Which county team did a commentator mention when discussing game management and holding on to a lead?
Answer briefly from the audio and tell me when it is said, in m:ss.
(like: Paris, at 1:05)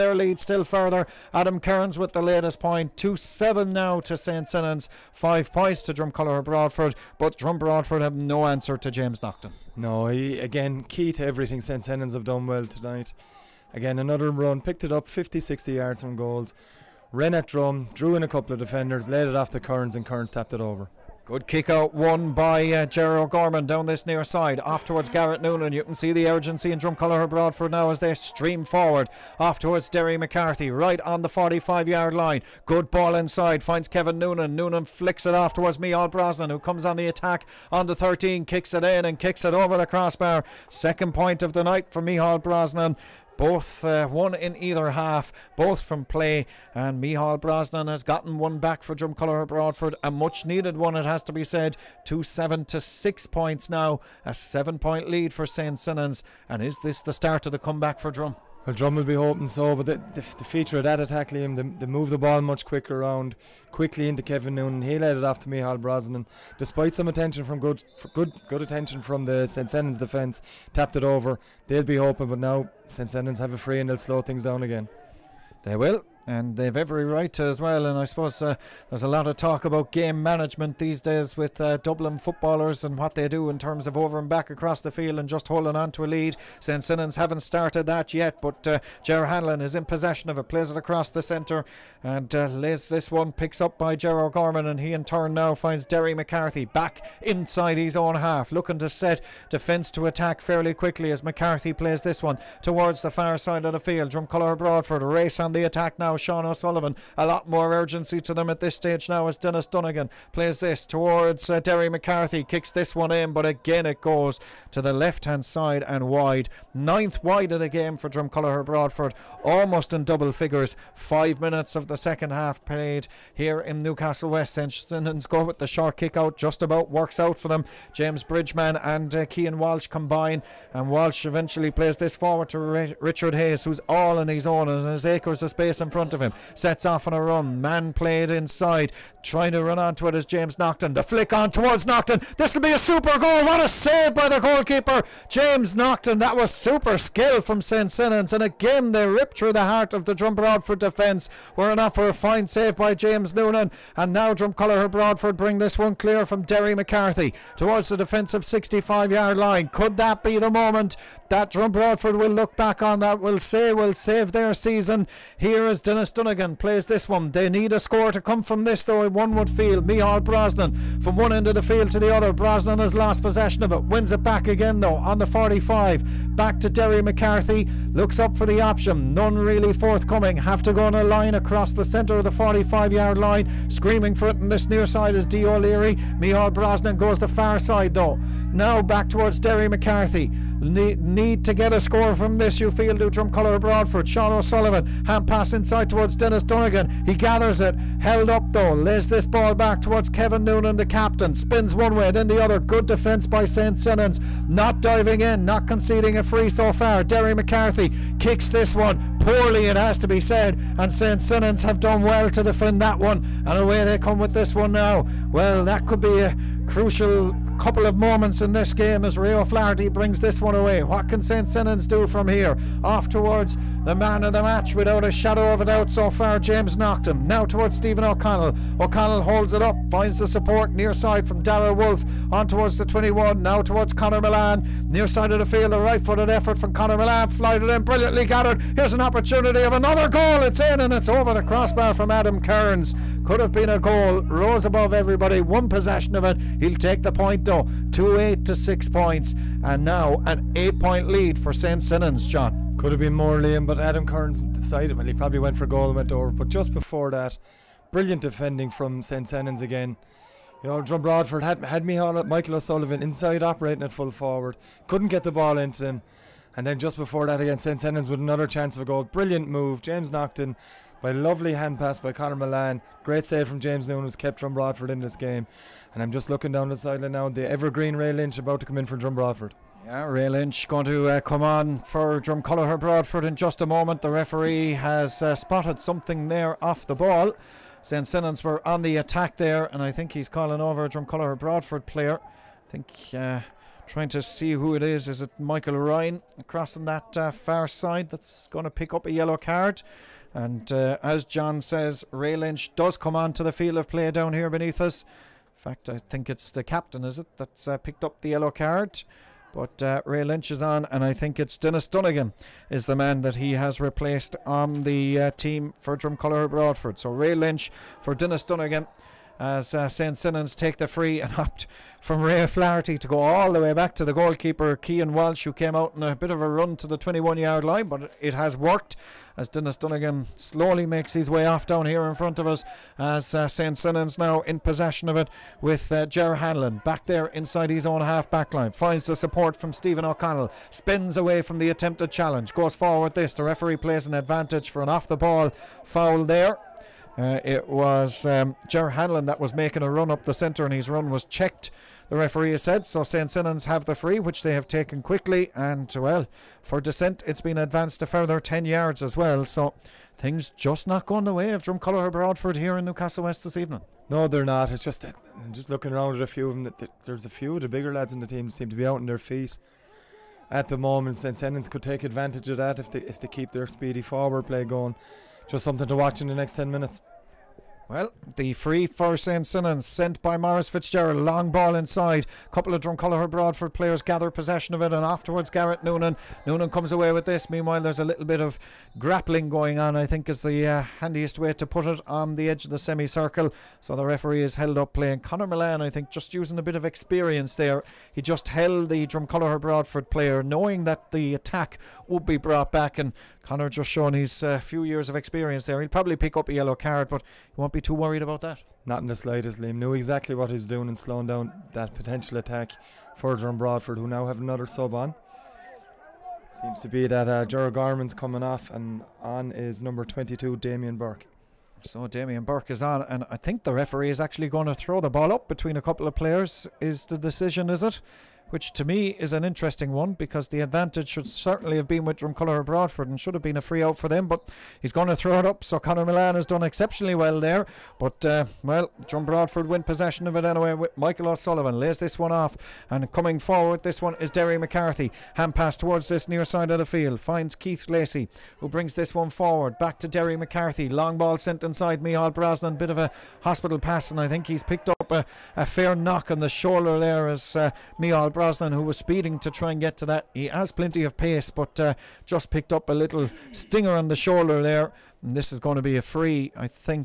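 Dublin, at 1:21.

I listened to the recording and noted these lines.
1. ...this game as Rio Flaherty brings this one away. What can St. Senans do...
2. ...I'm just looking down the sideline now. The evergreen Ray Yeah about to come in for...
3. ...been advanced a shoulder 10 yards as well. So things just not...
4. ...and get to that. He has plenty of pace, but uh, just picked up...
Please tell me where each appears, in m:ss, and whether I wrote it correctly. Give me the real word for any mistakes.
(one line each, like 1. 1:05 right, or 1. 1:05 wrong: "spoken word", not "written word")
1. 3:38 right
2. 4:36 wrong: "Lynch", not "Yeah"
3. 5:57 wrong: "further", not "shoulder"
4. 7:39 right.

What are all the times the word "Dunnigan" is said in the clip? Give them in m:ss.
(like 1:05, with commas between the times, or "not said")
1:49, 2:46, 5:11, 5:18, 5:29.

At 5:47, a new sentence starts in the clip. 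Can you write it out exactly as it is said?
Uh, it was um, Hanlon that was making a run up the centre and his run was checked, the referee said.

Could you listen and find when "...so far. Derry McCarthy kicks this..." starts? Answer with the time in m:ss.
3:26.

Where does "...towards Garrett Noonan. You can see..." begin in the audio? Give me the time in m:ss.
0:24.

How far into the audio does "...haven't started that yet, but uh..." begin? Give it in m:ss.
1:27.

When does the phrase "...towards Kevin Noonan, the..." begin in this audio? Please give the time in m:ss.
3:19.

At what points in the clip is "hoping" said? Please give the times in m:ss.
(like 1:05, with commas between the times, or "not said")
0:59, 1:11.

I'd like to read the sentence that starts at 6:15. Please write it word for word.
Just something to watch in the next 10 minutes.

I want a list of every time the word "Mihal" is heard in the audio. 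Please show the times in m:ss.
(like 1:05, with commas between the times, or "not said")
0:42, 0:47, 1:05, 2:49, 3:06, 7:32.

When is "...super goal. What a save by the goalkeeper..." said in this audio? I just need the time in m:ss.
2:22.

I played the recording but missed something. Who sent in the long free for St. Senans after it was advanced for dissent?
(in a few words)
Morris Fitzgerald.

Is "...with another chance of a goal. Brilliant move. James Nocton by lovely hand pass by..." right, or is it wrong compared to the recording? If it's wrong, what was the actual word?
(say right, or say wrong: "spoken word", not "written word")
right.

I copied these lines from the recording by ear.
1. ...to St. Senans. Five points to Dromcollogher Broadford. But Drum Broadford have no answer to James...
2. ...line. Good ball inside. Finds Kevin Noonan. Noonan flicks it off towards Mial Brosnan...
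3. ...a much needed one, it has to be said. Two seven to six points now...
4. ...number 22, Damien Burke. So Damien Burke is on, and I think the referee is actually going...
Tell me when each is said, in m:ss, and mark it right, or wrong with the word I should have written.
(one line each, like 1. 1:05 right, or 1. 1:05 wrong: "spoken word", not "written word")
1. 0:04 right
2. 0:32 right
3. 0:50 right
4. 6:59 right.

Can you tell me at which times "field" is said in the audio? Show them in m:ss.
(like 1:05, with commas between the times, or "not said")
1:24, 1:43, 2:51, 3:55, 5:03, 7:26.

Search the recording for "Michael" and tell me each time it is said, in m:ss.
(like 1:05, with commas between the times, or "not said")
4:21, 4:55, 7:20.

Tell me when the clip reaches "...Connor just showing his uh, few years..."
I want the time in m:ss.
6:43.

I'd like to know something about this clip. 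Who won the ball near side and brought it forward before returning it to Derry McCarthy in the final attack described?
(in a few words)
Keith Lacey.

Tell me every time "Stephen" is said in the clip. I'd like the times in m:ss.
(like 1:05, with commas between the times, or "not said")
3:47, 5:39.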